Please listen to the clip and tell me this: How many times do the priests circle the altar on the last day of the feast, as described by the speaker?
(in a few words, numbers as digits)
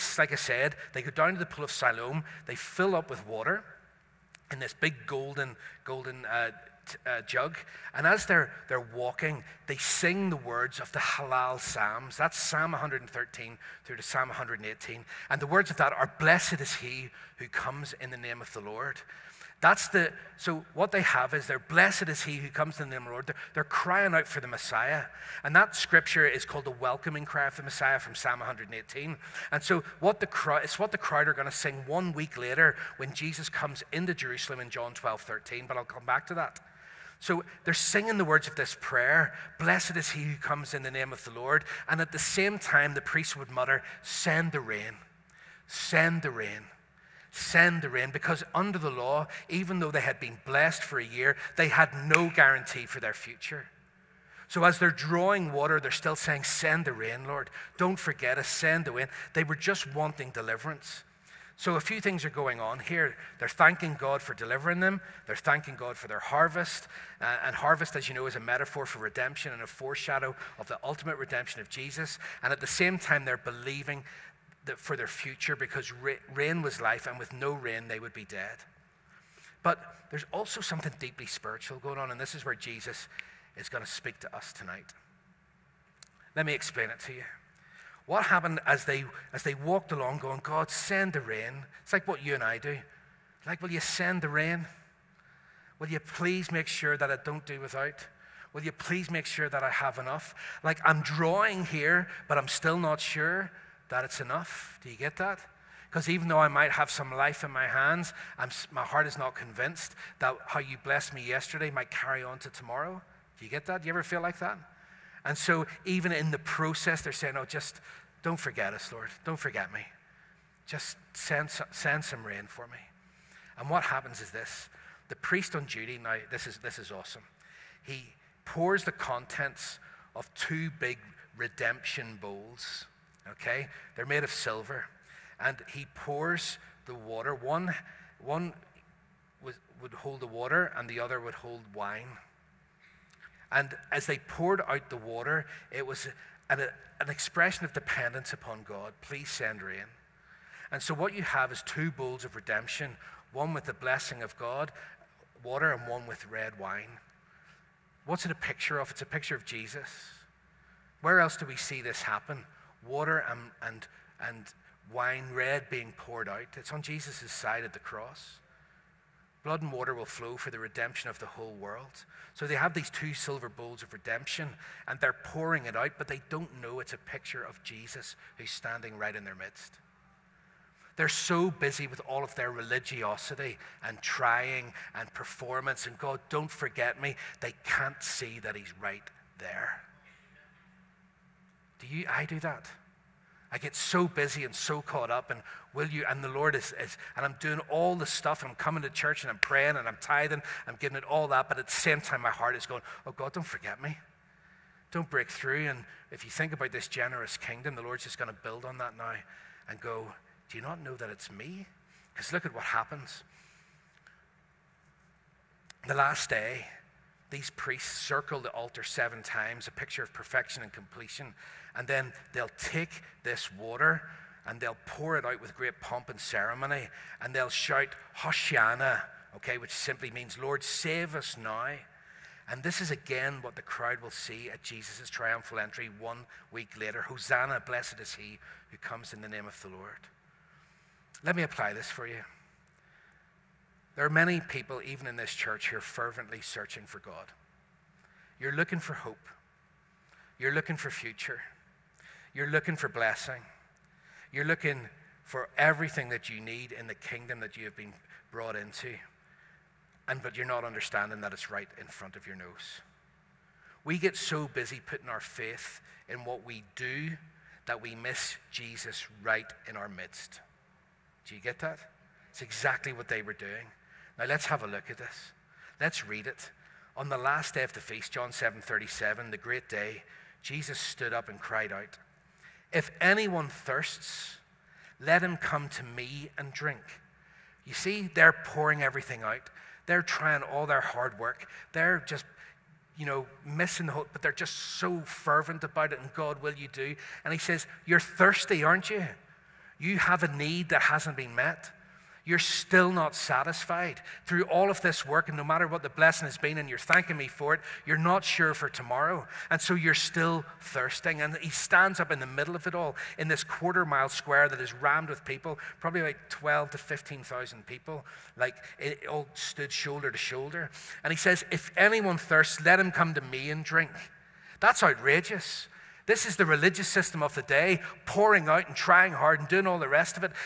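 7.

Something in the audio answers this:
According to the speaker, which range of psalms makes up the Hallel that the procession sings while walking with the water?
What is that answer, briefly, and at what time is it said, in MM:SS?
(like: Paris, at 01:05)
Psalm 113 to 118, at 00:12.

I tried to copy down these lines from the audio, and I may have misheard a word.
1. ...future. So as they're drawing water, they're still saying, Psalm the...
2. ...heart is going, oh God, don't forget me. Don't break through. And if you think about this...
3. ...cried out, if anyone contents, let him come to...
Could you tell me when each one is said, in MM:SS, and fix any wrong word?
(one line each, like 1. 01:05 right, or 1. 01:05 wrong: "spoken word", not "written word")
1. 00:53 wrong: "Send", not "Psalm"
2. 03:22 right
3. 04:41 wrong: "thirsts", not "contents".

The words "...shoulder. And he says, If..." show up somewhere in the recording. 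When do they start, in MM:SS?
05:20.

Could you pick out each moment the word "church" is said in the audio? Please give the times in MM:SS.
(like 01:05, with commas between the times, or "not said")
03:18, 04:05.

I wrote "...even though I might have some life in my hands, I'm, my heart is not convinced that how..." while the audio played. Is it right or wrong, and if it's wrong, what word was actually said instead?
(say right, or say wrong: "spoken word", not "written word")
right.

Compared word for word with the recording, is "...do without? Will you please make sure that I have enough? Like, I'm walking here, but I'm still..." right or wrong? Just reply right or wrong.
wrong.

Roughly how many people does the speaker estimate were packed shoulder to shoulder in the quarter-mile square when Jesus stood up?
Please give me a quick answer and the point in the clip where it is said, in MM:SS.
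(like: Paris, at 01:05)
12,000 to 15,000, at 05:16.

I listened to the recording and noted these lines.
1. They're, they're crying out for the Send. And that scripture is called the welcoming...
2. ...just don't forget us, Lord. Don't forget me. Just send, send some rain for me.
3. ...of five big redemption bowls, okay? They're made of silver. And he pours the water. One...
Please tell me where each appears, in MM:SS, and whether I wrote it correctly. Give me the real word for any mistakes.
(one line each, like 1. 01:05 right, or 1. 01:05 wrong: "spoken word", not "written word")
1. 00:23 wrong: "Messiah", not "Send"
2. 01:57 right
3. 02:10 wrong: "two", not "five".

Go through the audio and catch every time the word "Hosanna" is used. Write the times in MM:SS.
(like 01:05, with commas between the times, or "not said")
03:48, 03:56.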